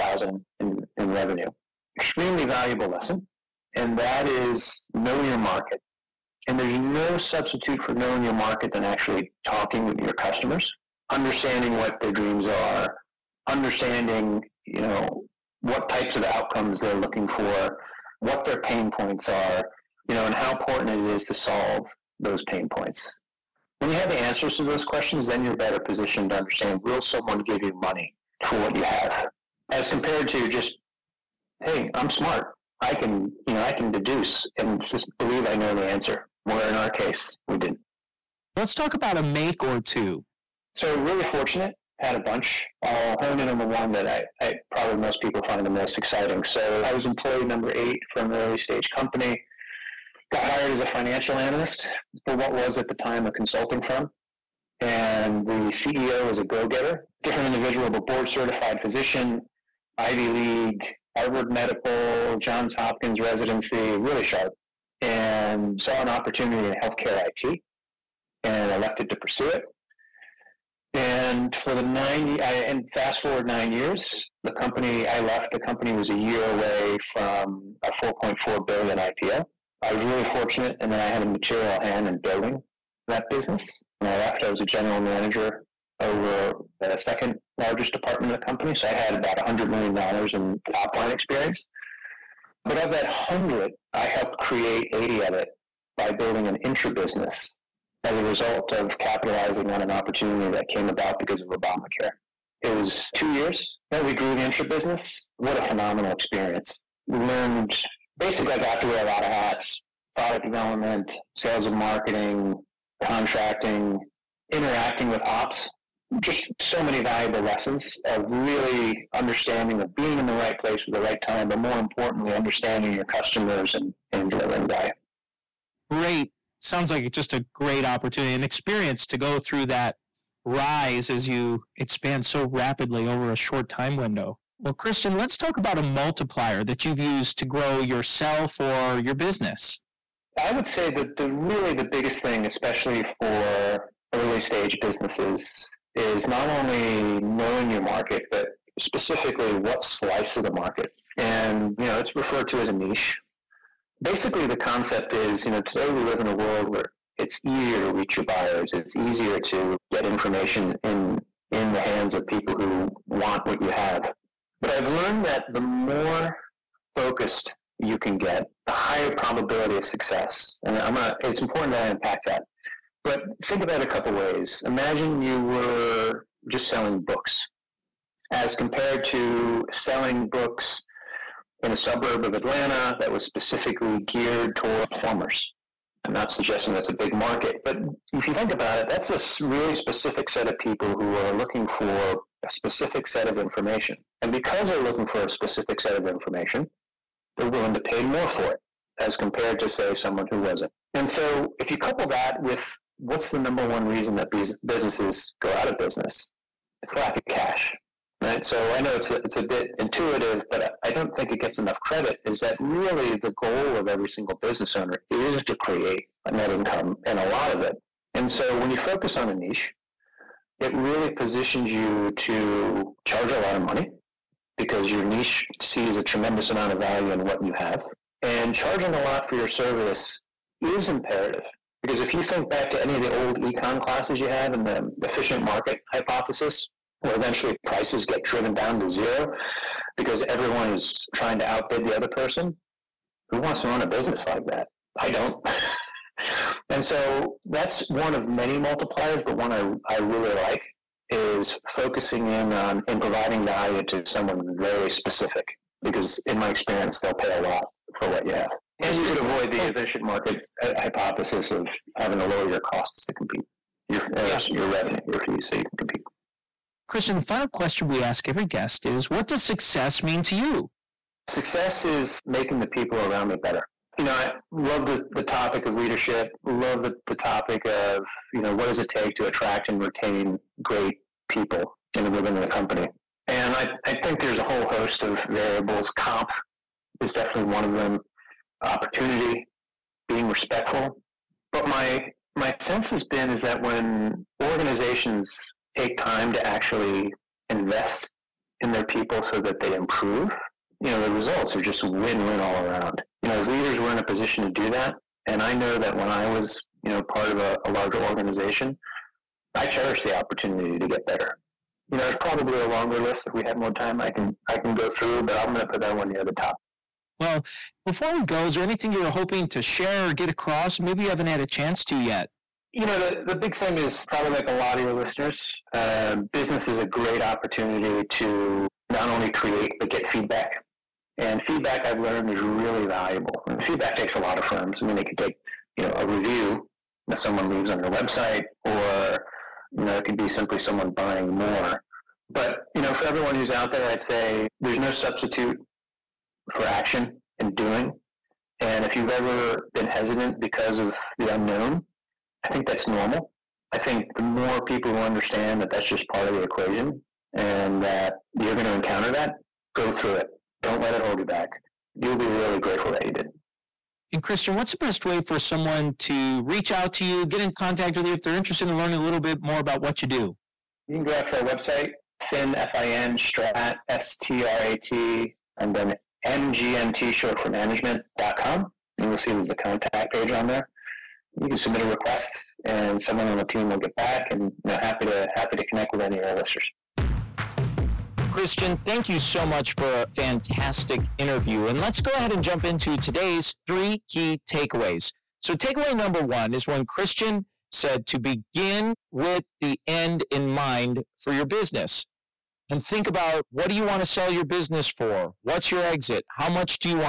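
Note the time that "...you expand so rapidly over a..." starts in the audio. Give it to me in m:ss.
2:11.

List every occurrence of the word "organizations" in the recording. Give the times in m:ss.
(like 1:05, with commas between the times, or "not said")
4:54, 5:07.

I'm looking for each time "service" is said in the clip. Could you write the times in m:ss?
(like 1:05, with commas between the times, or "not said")
3:49.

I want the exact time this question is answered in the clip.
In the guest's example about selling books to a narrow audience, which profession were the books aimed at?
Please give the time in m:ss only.
3:04.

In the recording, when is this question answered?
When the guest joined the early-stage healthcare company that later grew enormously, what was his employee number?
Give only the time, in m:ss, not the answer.
0:47.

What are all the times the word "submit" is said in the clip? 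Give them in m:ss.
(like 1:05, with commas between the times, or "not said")
6:21.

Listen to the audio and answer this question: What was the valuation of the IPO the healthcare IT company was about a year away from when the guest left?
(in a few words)
$4.4 billion.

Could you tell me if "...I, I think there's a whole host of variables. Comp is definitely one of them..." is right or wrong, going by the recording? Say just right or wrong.
right.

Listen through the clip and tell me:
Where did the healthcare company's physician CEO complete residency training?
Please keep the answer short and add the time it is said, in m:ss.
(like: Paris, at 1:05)
Johns Hopkins, at 1:02.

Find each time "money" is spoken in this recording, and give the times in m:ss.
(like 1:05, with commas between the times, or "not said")
0:27, 3:43.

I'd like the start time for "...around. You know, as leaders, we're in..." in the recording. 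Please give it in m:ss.
5:02.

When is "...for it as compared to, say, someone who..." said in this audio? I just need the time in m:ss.
3:18.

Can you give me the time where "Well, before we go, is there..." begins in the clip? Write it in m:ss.
5:17.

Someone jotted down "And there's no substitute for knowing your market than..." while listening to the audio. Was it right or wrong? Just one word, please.
right.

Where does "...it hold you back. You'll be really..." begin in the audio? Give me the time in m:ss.
6:00.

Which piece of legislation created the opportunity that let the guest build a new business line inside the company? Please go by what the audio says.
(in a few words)
Obamacare.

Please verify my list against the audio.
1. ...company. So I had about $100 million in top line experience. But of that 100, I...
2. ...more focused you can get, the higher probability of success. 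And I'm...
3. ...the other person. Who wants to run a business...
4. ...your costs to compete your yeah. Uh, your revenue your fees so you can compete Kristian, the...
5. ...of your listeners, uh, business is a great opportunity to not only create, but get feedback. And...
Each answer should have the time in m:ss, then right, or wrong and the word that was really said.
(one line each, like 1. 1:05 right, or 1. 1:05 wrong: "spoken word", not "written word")
1. 1:28 right
2. 2:45 right
3. 4:01 right
4. 4:22 right
5. 5:24 right.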